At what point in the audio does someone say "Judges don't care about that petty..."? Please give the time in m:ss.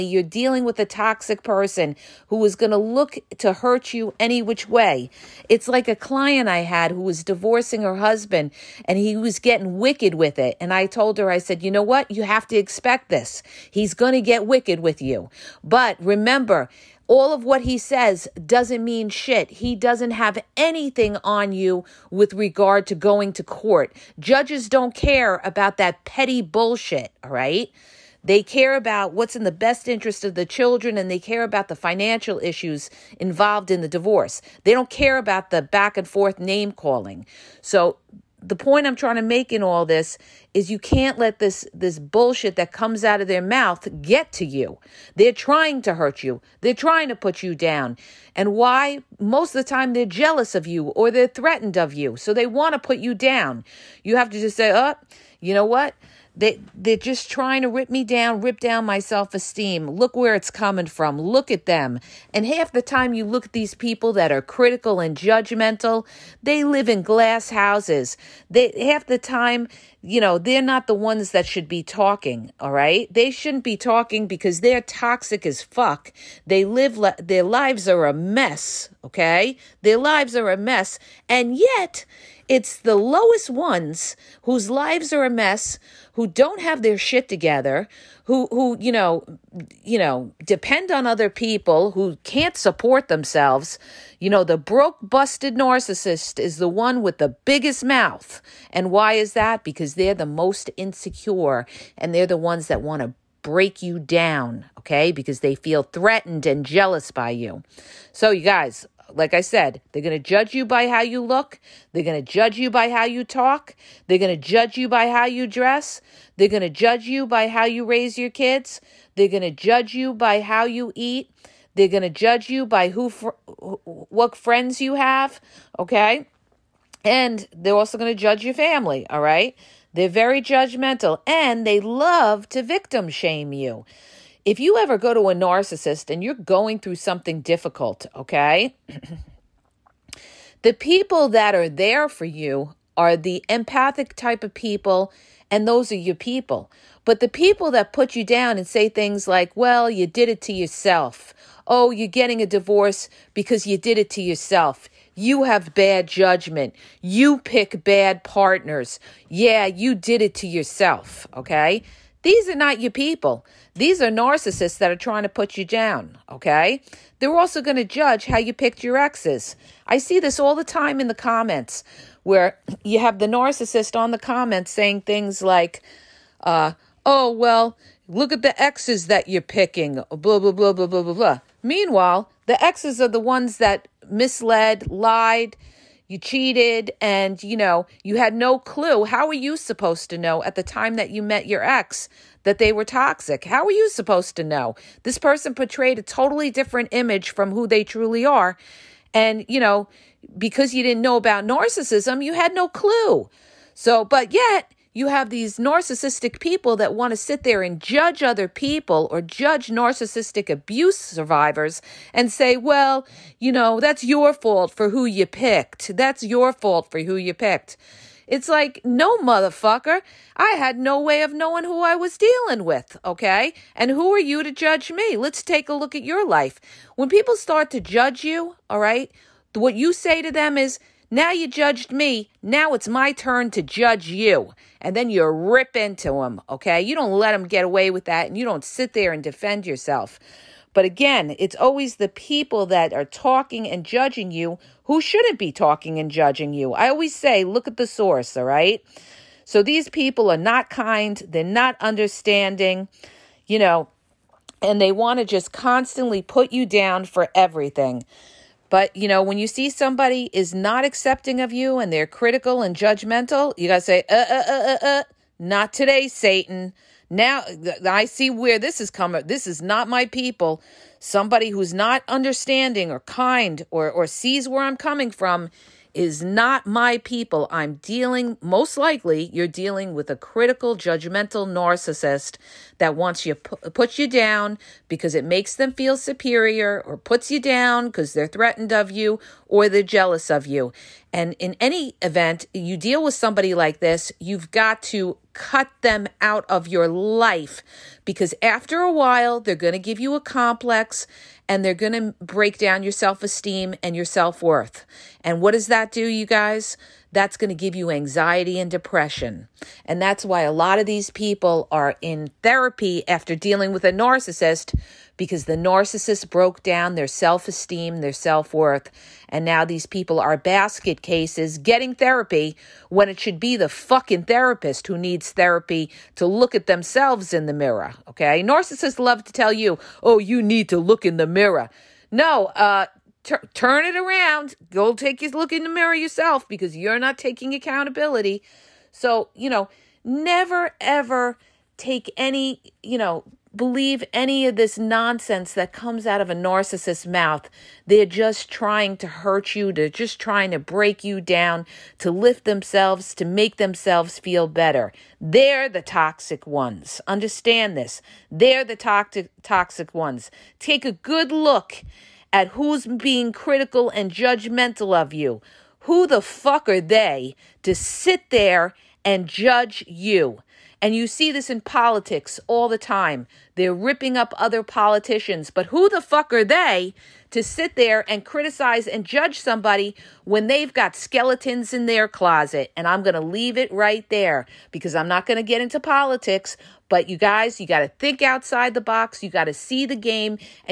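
0:24.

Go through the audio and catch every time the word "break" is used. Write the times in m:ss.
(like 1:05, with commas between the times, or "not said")
1:43, 5:02, 5:50.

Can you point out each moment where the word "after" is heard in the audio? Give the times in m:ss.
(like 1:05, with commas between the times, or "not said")
4:58, 5:13.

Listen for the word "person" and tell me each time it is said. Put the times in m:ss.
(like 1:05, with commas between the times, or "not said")
0:01, 3:15.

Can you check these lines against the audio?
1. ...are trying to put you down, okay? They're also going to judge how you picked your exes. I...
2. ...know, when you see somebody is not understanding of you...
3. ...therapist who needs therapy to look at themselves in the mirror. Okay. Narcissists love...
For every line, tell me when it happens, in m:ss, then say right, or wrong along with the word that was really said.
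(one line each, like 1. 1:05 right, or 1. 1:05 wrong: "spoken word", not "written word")
1. 2:44 right
2. 4:19 wrong: "accepting", not "understanding"
3. 5:24 right.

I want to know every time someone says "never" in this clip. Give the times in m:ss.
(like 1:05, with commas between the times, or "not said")
5:40.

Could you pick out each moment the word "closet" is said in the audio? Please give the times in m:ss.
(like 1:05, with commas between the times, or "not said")
6:22.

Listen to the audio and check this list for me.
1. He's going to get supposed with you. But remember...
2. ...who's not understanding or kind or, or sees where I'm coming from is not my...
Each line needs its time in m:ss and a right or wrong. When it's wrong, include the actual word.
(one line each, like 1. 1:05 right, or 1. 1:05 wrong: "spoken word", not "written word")
1. 0:13 wrong: "wicked", not "supposed"
2. 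4:31 right.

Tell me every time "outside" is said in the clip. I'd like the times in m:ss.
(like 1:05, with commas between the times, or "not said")
6:28.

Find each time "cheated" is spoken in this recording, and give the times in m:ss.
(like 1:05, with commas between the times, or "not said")
3:06.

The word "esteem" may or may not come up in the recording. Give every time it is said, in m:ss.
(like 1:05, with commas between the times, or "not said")
0:59, 5:03, 5:17.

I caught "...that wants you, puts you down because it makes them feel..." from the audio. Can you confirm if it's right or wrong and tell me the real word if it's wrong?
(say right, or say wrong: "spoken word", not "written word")
right.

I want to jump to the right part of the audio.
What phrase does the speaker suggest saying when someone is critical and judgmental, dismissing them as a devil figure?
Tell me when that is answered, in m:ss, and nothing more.
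4:25.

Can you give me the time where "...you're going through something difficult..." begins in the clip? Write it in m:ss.
2:16.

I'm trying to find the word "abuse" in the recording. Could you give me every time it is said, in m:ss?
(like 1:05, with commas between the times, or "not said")
3:30.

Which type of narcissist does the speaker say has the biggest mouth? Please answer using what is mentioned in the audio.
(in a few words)
Broke busted narcissist.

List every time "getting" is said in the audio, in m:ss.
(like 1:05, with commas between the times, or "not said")
0:09, 2:32, 5:21.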